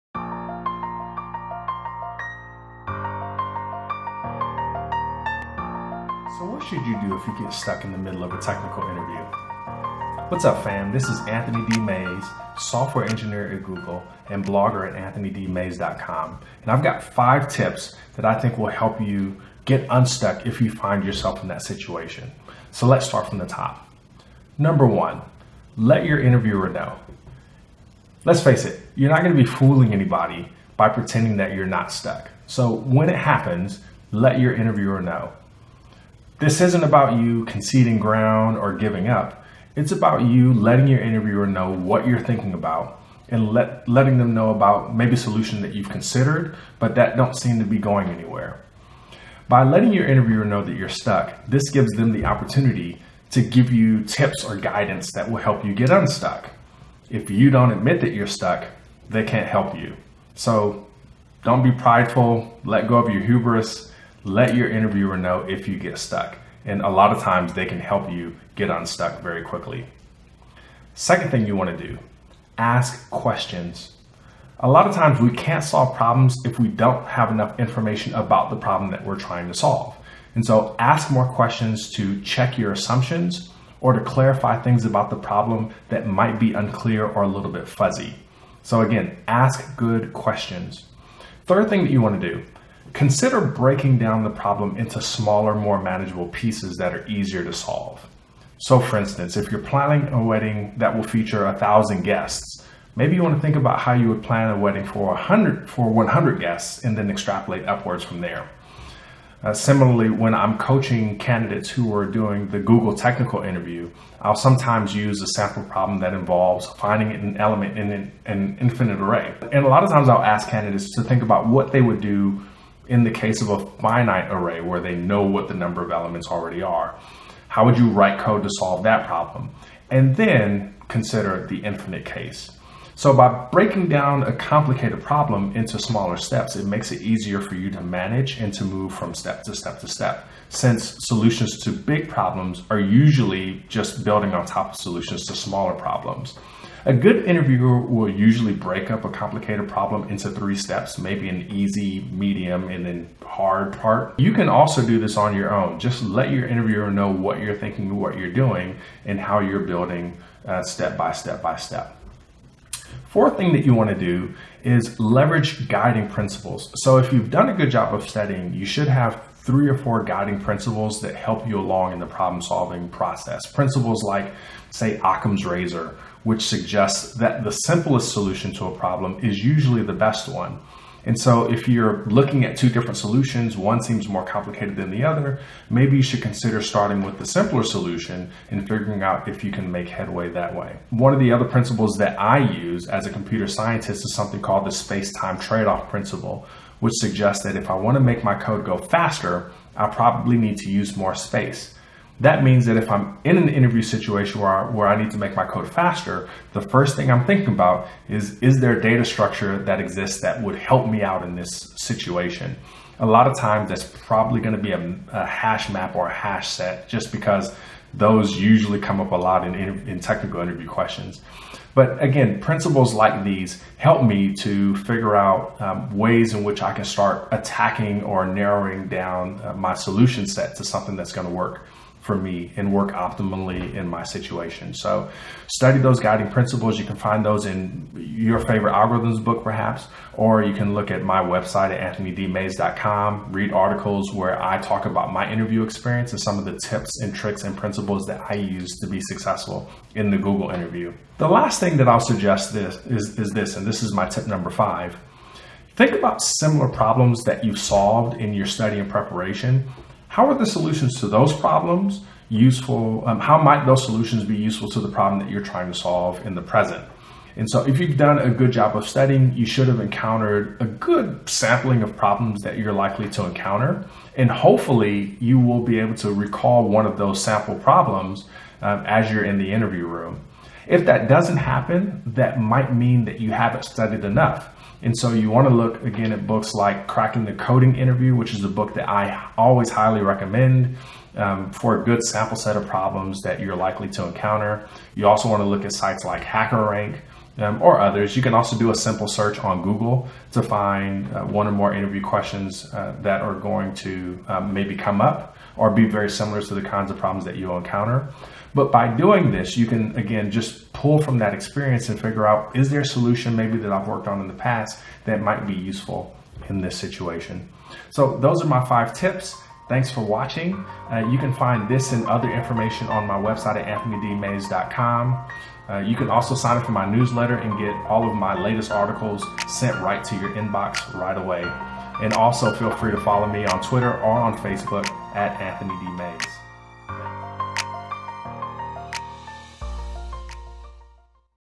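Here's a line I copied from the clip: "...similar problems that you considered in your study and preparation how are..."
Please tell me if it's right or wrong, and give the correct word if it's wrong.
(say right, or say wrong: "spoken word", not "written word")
wrong: "solved", not "considered".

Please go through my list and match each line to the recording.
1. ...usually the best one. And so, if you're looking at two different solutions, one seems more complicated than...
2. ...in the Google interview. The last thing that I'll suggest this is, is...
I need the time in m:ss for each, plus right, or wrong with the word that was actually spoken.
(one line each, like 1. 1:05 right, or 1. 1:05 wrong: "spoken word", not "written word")
1. 2:59 right
2. 4:09 right.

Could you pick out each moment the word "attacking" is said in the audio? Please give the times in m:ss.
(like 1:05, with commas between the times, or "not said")
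3:47.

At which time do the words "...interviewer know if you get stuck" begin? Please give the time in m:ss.
1:04.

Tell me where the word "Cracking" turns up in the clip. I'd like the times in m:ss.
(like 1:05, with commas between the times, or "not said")
4:46.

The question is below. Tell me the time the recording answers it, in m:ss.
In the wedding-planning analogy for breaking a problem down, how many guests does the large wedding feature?
1:41.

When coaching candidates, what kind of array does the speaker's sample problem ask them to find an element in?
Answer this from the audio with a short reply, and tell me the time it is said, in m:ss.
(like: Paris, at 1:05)
An infinite array, at 1:58.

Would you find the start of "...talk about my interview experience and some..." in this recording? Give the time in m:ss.
4:04.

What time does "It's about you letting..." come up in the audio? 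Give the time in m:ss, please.
0:39.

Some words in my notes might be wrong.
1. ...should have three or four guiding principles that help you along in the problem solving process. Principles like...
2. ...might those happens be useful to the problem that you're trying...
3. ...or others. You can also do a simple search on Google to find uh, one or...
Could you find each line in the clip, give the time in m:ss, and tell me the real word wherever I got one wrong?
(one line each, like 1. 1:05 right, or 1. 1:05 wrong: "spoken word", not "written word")
1. 2:48 right
2. 4:23 wrong: "solutions", not "happens"
3. 4:57 right.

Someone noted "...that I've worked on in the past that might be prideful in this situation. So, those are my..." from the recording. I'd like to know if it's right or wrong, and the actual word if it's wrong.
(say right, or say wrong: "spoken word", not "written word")
wrong: "useful", not "prideful".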